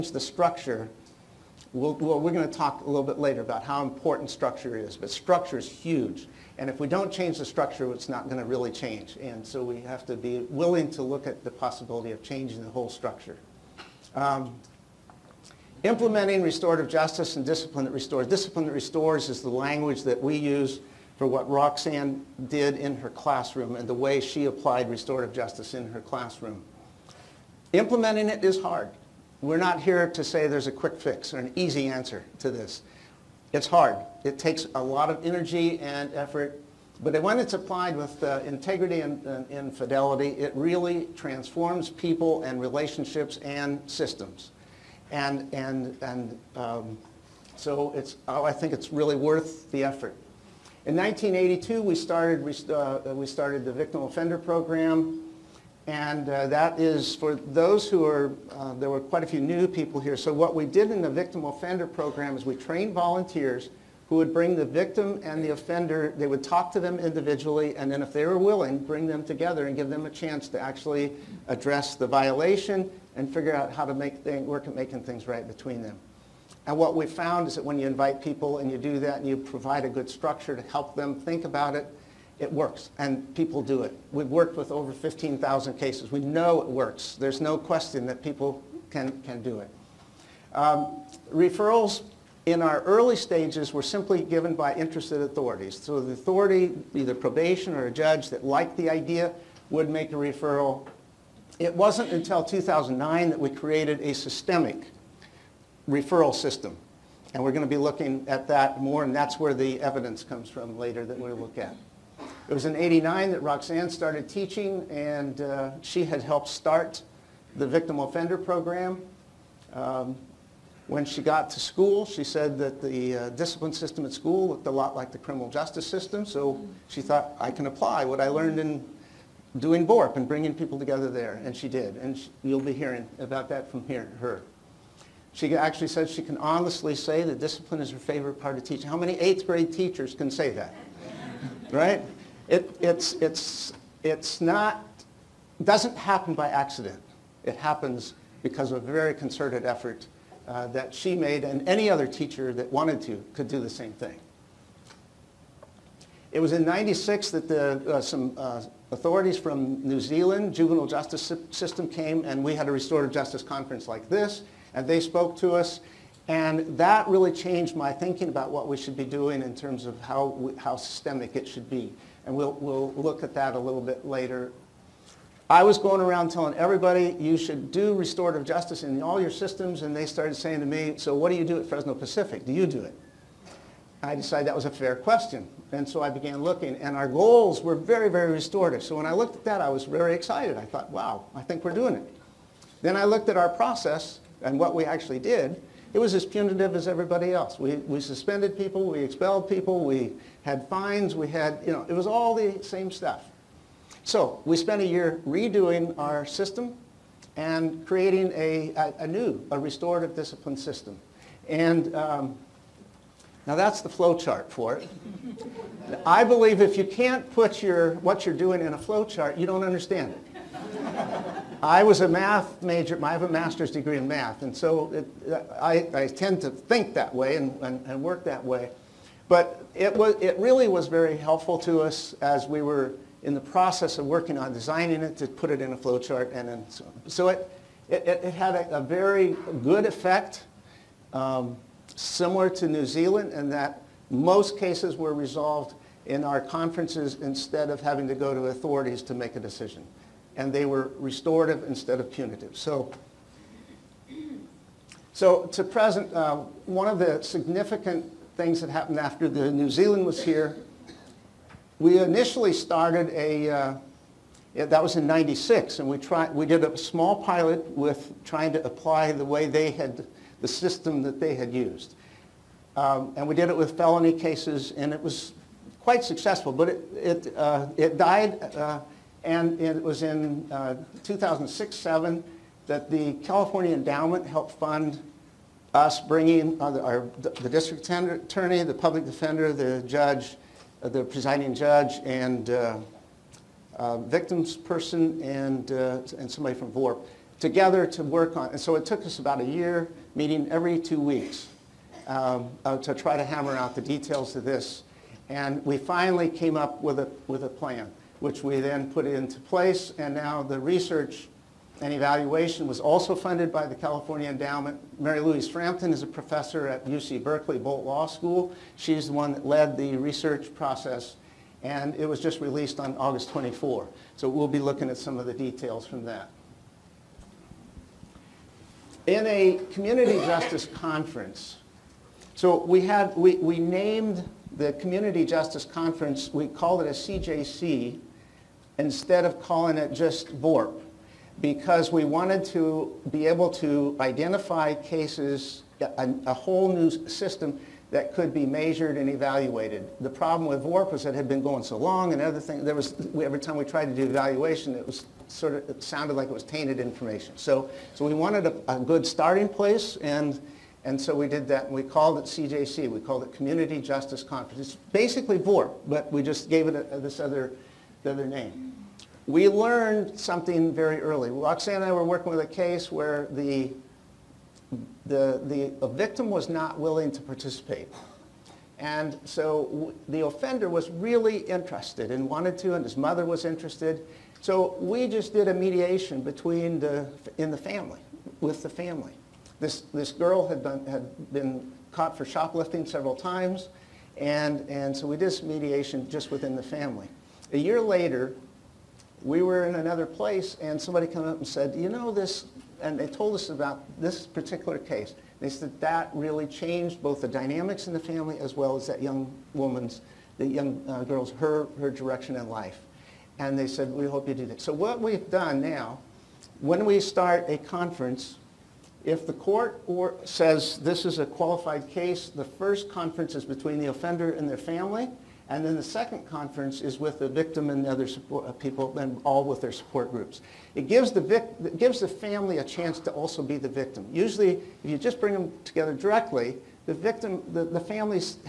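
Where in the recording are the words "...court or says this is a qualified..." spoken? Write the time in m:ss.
6:59.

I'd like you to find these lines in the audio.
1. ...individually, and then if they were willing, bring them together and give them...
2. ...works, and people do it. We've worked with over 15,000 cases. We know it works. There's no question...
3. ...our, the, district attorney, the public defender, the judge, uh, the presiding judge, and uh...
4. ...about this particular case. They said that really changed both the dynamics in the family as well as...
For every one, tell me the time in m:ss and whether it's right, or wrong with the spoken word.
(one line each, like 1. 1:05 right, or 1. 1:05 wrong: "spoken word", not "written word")
1. 1:06 right
2. 1:22 right
3. 4:46 right
4. 6:43 right.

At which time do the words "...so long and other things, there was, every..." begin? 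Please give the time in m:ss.
5:51.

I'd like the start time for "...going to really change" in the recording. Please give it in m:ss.
0:08.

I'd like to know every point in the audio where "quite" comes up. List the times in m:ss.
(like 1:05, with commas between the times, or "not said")
0:58, 4:35.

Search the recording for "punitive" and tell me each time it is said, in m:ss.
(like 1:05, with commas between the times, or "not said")
3:16, 4:12.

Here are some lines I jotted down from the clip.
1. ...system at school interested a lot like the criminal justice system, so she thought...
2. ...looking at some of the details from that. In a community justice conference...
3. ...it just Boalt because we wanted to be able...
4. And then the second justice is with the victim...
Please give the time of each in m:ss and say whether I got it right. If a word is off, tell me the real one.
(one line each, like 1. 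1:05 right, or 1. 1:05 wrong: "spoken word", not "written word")
1. 2:03 wrong: "looked", not "interested"
2. 5:24 right
3. 5:39 wrong: "VORP", not "Boalt"
4. 7:05 wrong: "conference", not "justice".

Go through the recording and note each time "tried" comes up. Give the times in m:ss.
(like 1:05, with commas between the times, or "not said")
4:25, 5:53.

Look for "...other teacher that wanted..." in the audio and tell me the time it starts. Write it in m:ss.
2:31.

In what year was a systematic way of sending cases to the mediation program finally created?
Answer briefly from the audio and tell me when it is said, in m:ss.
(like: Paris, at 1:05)
2009, at 1:42.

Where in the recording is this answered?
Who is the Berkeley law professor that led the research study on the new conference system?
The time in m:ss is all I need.
5:15.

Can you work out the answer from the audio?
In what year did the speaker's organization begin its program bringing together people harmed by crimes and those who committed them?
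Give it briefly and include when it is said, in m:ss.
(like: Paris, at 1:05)
1982, at 0:50.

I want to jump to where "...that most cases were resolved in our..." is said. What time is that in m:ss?
4:03.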